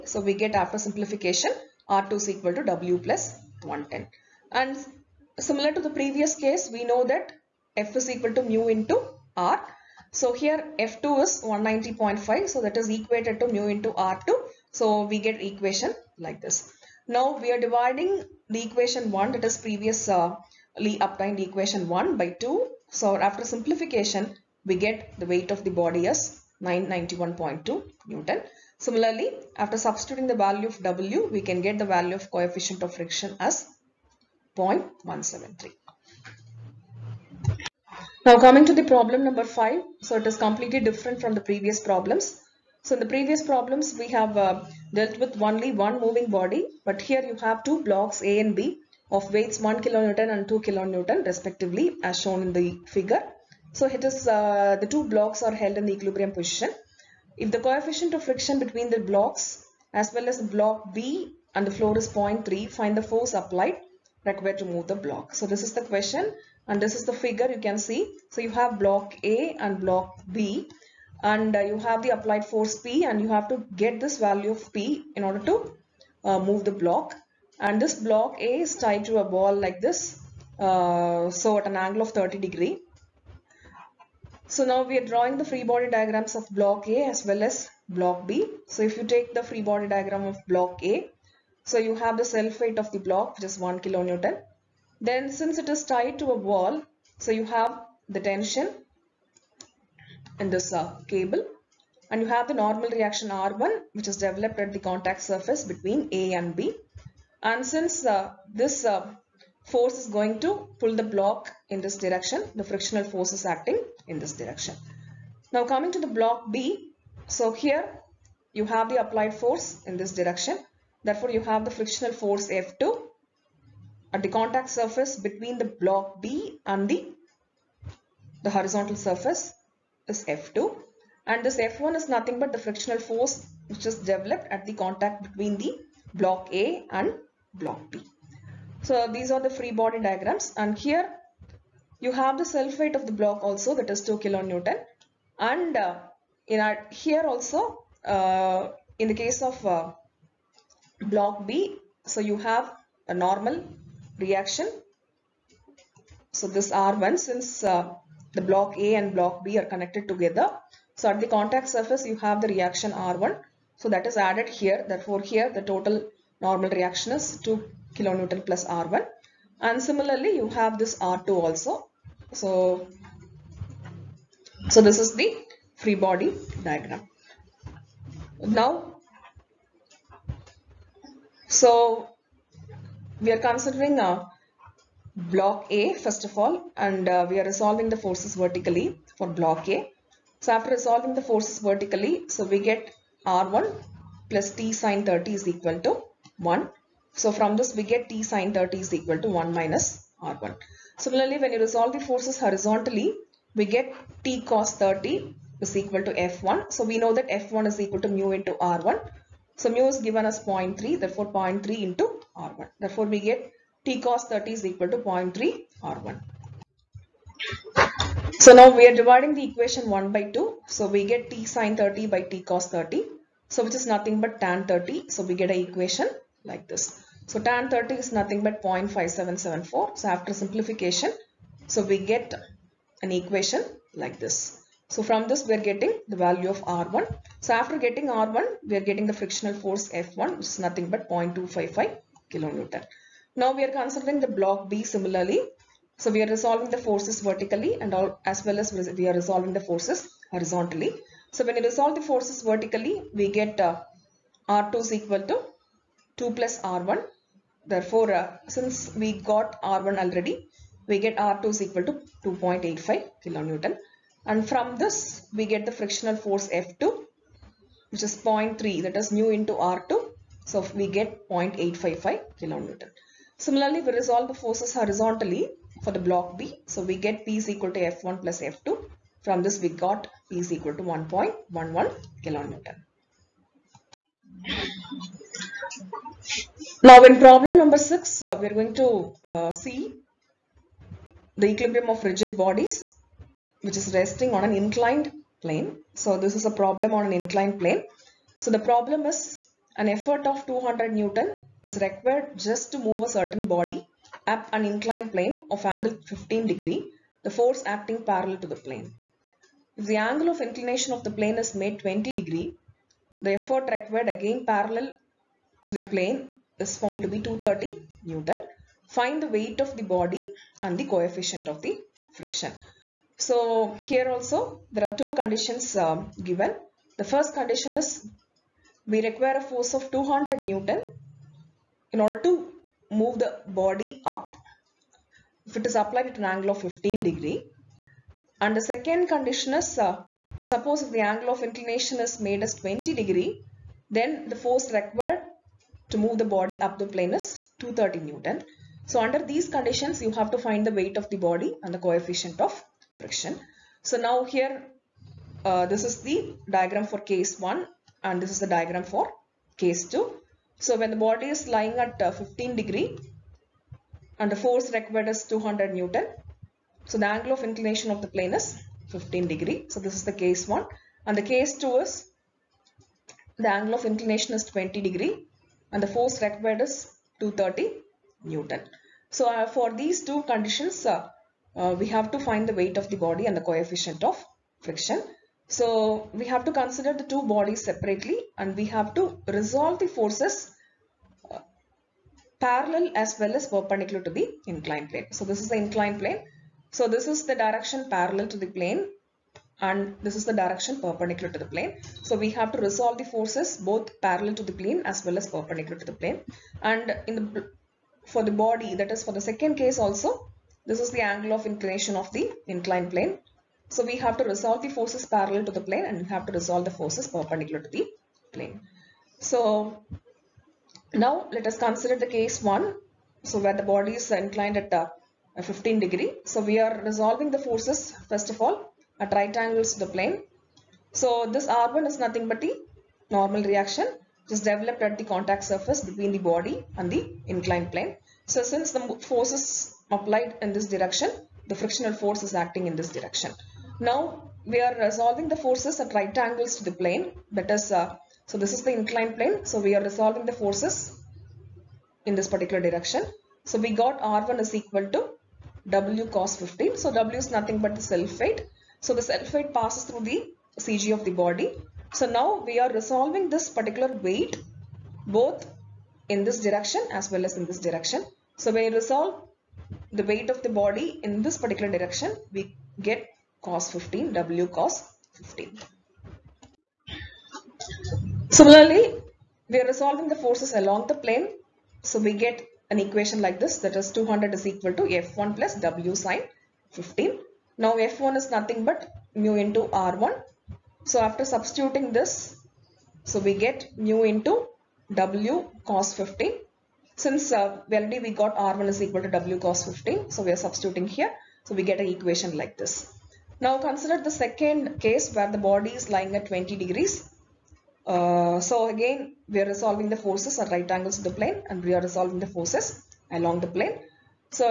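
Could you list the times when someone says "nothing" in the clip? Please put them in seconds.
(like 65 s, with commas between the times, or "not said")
132 s, 223 s, 228 s, 240 s, 431 s, 457 s, 488 s.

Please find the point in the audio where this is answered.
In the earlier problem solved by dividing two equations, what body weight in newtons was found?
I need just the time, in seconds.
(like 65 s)
26 s.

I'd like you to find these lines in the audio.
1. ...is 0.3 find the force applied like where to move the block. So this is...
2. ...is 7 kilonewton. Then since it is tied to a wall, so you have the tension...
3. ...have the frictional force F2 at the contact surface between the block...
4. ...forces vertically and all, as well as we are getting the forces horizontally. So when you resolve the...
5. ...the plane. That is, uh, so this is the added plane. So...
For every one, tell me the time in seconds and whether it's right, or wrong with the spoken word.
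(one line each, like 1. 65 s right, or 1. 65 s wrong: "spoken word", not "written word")
1. 61 s right
2. 93 s wrong: "1", not "7"
3. 121 s right
4. 246 s wrong: "resolving", not "getting"
5. 446 s wrong: "inclined", not "added".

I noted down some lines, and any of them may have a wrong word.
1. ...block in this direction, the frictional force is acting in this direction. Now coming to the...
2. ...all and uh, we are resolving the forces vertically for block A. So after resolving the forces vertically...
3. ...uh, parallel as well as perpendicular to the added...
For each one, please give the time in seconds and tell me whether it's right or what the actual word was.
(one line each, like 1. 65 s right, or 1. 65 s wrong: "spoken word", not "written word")
1. 111 s right
2. 186 s right
3. 391 s wrong: "inclined", not "added".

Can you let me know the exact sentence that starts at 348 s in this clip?
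So under these conditions you have to find the weight of the body and the coefficient of friction.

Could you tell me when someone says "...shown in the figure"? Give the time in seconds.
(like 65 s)
52 s.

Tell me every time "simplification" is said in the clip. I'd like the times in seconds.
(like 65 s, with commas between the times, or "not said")
0 s, 23 s, 230 s.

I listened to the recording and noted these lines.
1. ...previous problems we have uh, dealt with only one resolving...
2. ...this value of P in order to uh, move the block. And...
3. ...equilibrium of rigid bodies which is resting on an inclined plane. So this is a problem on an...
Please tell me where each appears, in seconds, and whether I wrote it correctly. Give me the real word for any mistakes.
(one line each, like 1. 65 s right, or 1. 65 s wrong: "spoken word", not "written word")
1. 43 s wrong: "moving", not "resolving"
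2. 73 s right
3. 291 s right.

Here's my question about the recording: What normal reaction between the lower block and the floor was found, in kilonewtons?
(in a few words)
2.85 kN.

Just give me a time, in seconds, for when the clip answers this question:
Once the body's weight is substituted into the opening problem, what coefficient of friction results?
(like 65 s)
34 s.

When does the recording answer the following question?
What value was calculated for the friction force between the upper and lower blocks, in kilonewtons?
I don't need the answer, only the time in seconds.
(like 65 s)
241 s.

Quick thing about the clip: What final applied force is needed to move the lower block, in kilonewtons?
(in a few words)
1.11 kN.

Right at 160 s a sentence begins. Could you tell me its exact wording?
So at the contact surface you have the reaction R1.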